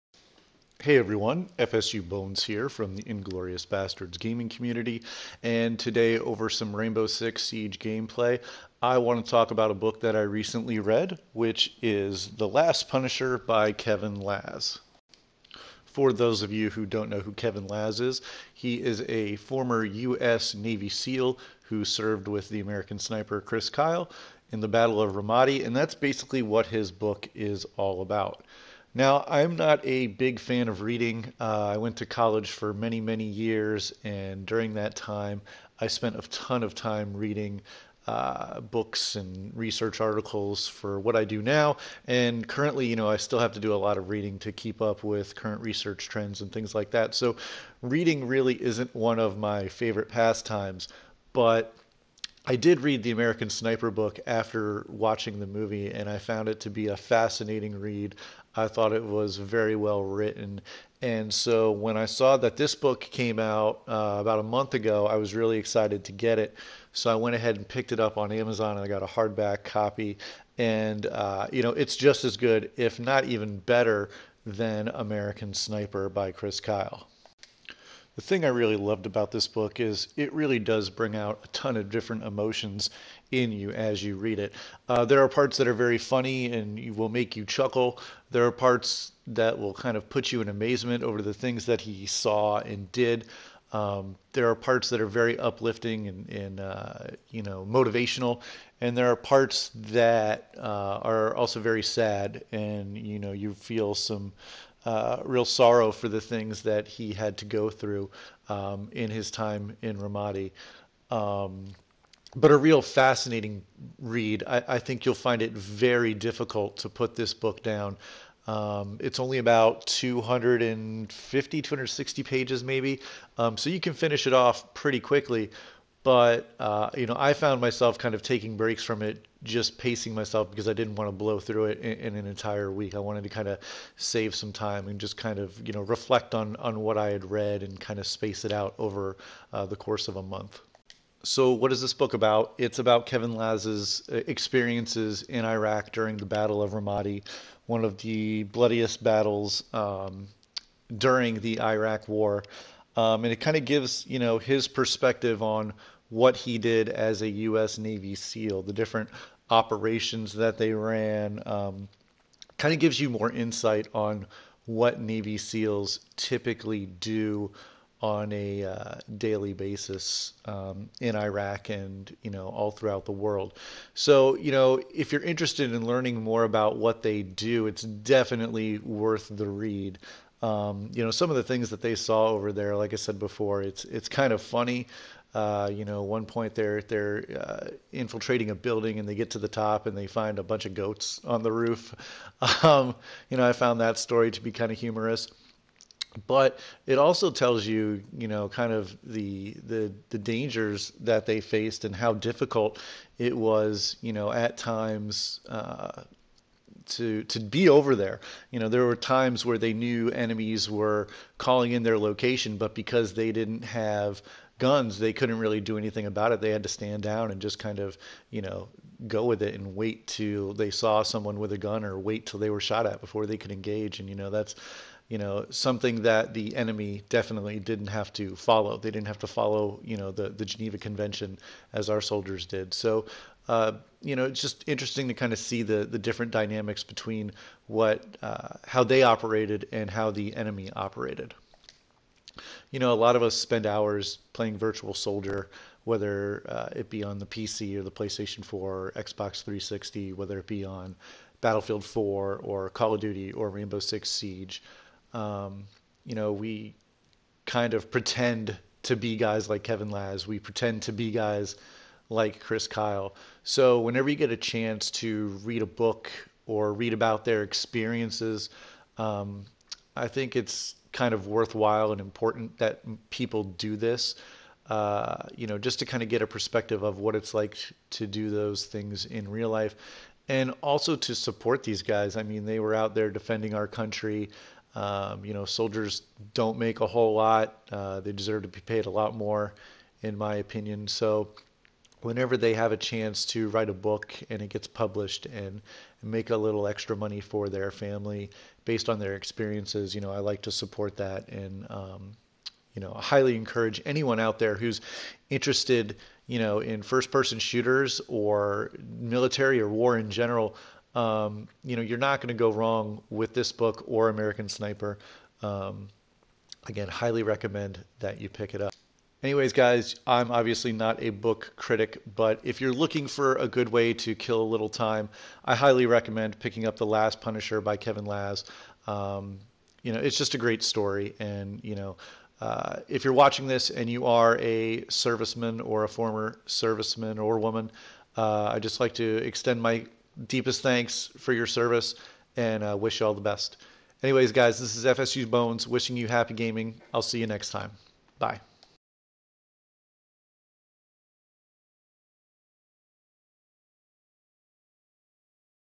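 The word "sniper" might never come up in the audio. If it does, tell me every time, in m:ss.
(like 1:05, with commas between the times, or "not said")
0:22, 0:53, 1:15, 5:14.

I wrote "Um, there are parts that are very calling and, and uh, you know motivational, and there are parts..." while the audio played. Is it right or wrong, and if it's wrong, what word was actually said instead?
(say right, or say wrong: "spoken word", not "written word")
wrong: "uplifting", not "calling".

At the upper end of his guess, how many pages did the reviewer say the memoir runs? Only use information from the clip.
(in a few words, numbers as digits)
260.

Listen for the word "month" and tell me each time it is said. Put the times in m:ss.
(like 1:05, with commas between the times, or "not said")
1:04, 2:20.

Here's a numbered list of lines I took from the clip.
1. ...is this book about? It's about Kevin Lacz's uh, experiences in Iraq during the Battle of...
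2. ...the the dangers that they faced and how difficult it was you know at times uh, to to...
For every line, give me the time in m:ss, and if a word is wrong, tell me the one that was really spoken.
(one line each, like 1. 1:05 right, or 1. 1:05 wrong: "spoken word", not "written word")
1. 2:21 right
2. 3:19 right.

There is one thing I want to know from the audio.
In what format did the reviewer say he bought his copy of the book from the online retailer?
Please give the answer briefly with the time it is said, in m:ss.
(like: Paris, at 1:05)
hardback, at 1:09.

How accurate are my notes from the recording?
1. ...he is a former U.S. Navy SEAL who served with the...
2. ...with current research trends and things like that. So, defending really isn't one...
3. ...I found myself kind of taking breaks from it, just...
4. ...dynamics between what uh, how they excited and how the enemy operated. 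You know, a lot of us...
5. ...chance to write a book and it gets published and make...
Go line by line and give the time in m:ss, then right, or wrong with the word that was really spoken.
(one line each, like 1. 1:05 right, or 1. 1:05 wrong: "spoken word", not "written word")
1. 0:18 right
2. 0:45 wrong: "reading", not "defending"
3. 2:07 right
4. 3:56 wrong: "operated", not "excited"
5. 4:52 right.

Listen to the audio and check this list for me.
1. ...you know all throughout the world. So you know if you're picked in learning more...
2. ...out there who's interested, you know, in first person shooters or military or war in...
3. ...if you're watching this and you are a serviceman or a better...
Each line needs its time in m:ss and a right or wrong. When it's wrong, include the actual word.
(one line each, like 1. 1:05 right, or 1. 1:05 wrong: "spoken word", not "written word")
1. 2:52 wrong: "interested", not "picked"
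2. 5:04 right
3. 5:32 wrong: "former", not "better".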